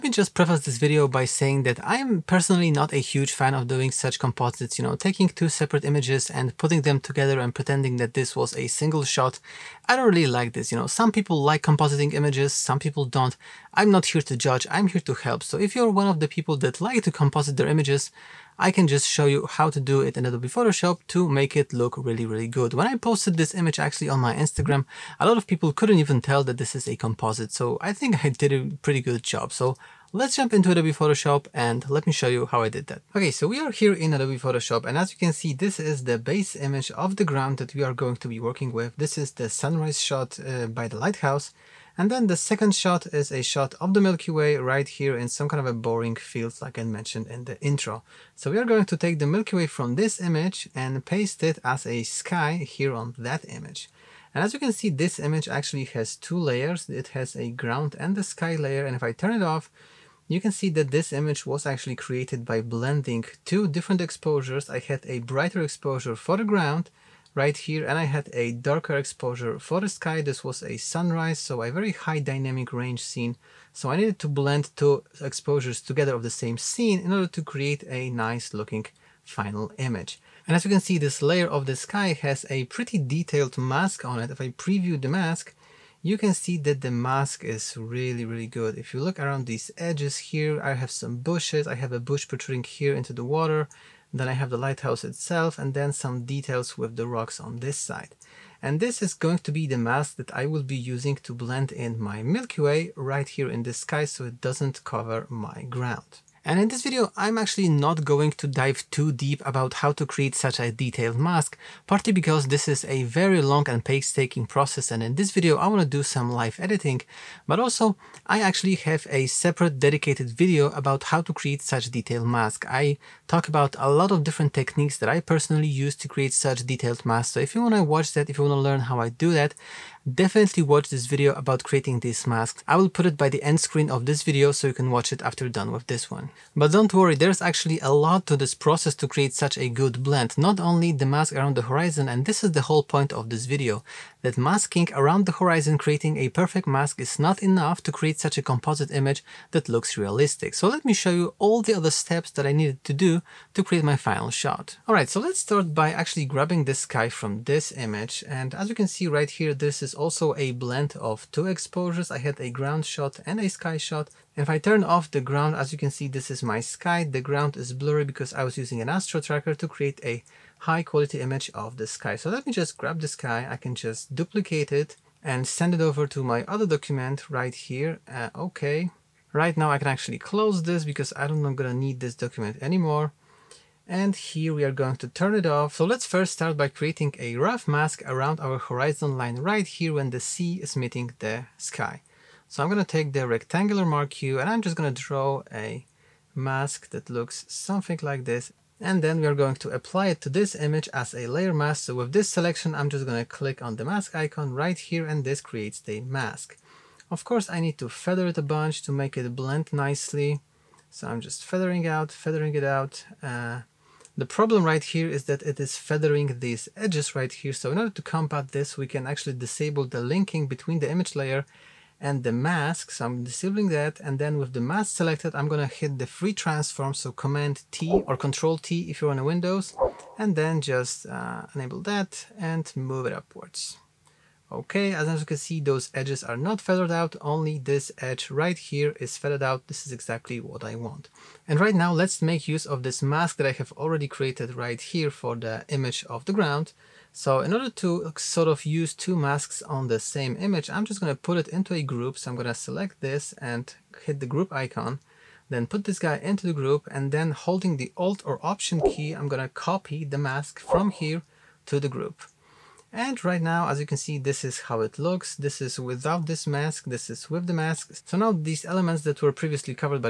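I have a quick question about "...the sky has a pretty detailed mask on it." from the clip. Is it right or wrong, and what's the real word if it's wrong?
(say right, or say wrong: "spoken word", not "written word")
right.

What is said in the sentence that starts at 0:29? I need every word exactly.
So Let's jump into Adobe Photoshop and let me show you how I did that.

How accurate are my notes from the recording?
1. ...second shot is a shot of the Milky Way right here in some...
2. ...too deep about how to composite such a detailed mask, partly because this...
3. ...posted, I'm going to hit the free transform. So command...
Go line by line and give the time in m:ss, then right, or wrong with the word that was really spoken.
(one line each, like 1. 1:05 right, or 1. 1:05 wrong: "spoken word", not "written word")
1. 0:42 right
2. 1:48 wrong: "create", not "composite"
3. 3:44 wrong: "selected", not "posted".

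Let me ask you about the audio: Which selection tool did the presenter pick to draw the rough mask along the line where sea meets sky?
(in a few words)
rectangular marquee.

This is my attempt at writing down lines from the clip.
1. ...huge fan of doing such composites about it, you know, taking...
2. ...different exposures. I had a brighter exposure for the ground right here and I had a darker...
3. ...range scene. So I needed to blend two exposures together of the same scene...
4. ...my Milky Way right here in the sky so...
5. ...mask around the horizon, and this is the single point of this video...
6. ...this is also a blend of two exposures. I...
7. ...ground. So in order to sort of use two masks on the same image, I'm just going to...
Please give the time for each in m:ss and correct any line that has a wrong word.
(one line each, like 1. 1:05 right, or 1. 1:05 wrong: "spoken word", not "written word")
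1. 0:02 right
2. 1:03 right
3. 1:12 right
4. 1:42 right
5. 2:21 wrong: "whole", not "single"
6. 2:39 right
7. 4:06 right.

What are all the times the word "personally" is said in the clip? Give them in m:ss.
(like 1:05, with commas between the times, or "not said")
0:02, 2:05.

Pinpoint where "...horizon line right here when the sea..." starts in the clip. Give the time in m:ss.
3:08.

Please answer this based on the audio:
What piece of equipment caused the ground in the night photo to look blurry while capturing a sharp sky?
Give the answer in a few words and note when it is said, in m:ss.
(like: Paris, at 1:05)
astro tracker, at 2:48.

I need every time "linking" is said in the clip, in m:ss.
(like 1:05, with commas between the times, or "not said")
3:40.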